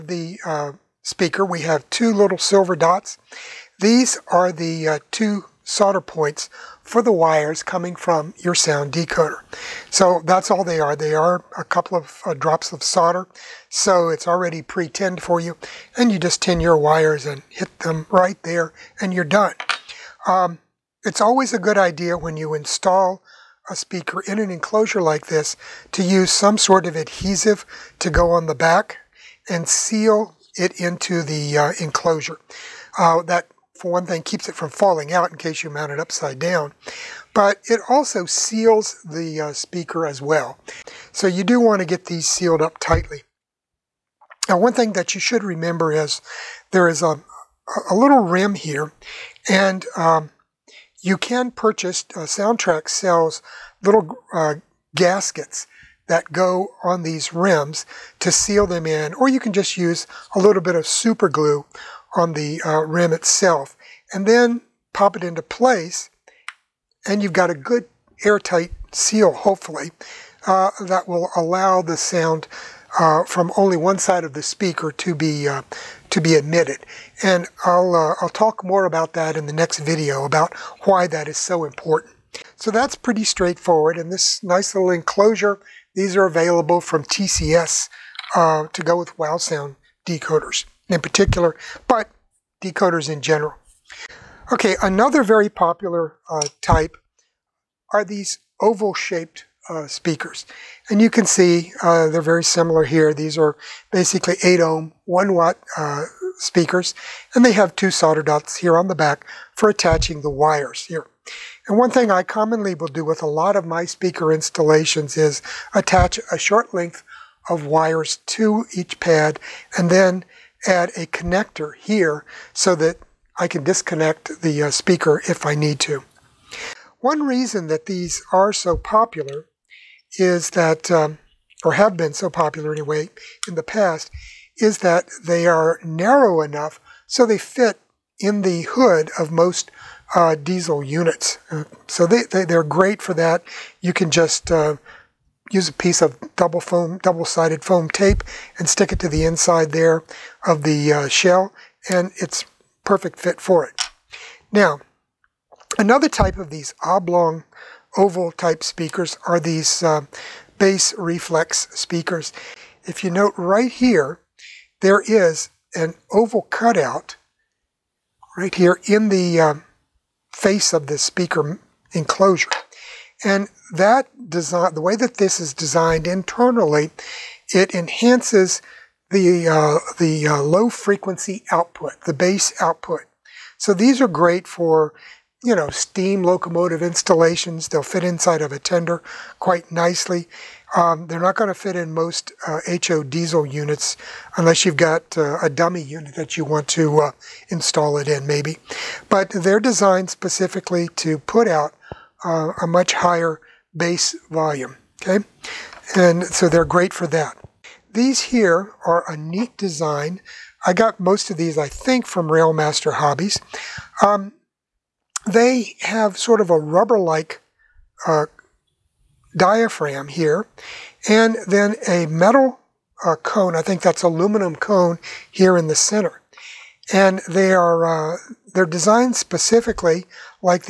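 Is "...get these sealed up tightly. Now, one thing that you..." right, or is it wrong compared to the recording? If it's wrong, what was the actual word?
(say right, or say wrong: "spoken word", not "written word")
right.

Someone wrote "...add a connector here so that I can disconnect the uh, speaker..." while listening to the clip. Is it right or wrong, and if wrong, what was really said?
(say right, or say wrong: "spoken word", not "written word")
right.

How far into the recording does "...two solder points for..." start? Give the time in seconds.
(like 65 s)
5 s.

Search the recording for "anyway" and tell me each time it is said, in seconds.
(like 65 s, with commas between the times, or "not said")
132 s.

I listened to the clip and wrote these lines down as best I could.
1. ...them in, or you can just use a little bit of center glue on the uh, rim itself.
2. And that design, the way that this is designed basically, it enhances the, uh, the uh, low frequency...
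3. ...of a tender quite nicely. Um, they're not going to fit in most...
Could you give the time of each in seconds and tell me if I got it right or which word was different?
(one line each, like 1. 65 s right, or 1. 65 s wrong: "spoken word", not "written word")
1. 58 s wrong: "super", not "center"
2. 173 s wrong: "internally", not "basically"
3. 188 s right.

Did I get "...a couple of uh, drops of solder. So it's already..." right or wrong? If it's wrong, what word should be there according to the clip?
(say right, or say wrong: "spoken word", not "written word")
right.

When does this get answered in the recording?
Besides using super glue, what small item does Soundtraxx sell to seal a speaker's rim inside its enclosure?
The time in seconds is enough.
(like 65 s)
54 s.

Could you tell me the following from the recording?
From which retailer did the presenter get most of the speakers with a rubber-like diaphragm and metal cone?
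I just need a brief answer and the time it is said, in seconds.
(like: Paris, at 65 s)
Railmaster Hobbies, at 212 s.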